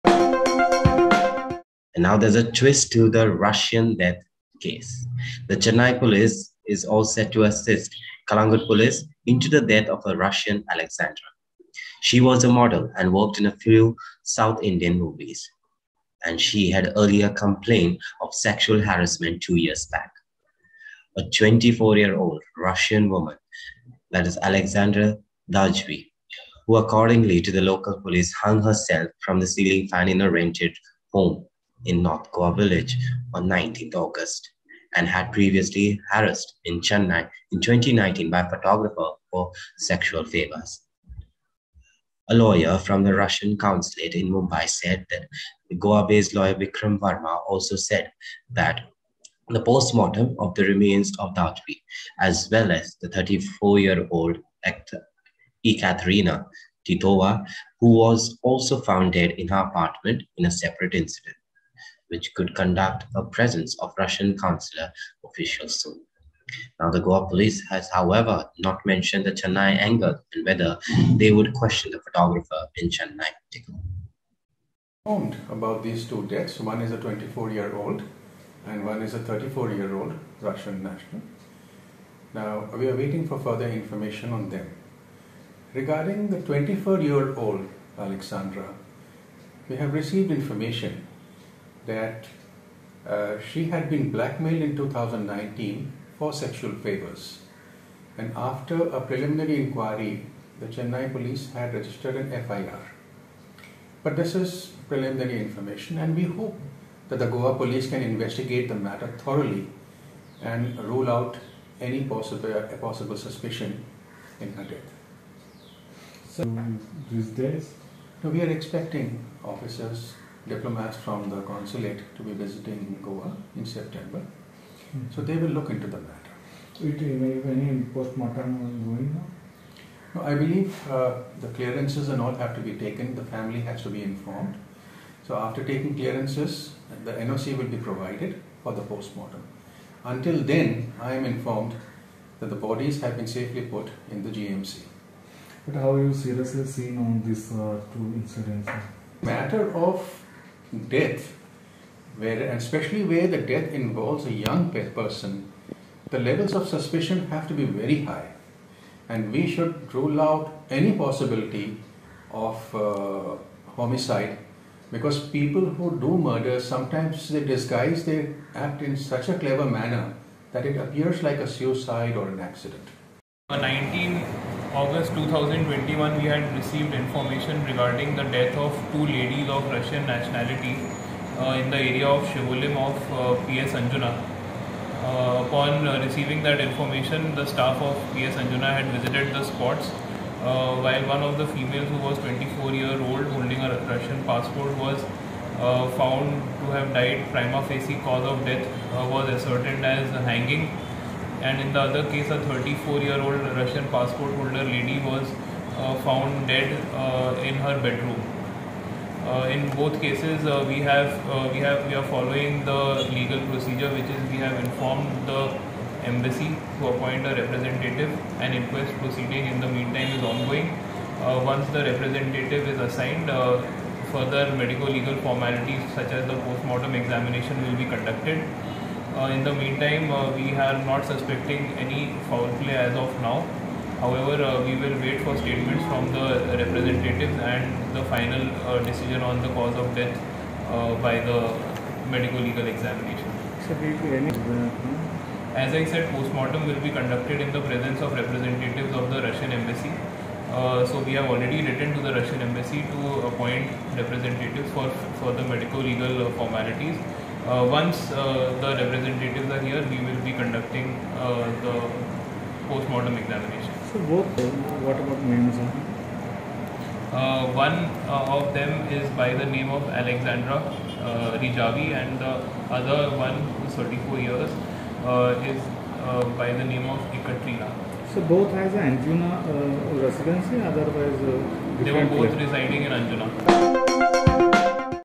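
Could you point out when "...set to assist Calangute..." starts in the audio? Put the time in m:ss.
0:07.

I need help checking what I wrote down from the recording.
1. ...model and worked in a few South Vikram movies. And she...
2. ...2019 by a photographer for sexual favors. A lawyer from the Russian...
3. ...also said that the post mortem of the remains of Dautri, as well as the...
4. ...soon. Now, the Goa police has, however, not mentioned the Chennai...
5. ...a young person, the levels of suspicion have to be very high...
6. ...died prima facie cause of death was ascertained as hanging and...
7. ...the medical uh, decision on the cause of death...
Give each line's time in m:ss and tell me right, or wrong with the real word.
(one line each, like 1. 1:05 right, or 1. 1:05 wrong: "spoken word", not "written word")
1. 0:12 wrong: "Indian", not "Vikram"
2. 0:37 right
3. 0:47 right
4. 1:05 right
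5. 2:34 right
6. 3:16 right
7. 3:57 wrong: "final", not "medical".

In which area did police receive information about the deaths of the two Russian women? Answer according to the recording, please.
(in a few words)
Shivolim.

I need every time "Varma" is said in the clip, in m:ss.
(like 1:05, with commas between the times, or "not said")
0:46.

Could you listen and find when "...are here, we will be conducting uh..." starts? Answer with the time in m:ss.
4:19.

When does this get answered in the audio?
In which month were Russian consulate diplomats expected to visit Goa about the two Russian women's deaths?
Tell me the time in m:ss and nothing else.
2:03.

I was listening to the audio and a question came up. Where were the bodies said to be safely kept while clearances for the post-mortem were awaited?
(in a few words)
GMC.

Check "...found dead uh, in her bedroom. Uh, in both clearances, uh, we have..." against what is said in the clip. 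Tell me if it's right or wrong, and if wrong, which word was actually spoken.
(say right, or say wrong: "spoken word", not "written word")
wrong: "cases", not "clearances".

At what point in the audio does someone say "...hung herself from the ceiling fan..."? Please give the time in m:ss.
0:28.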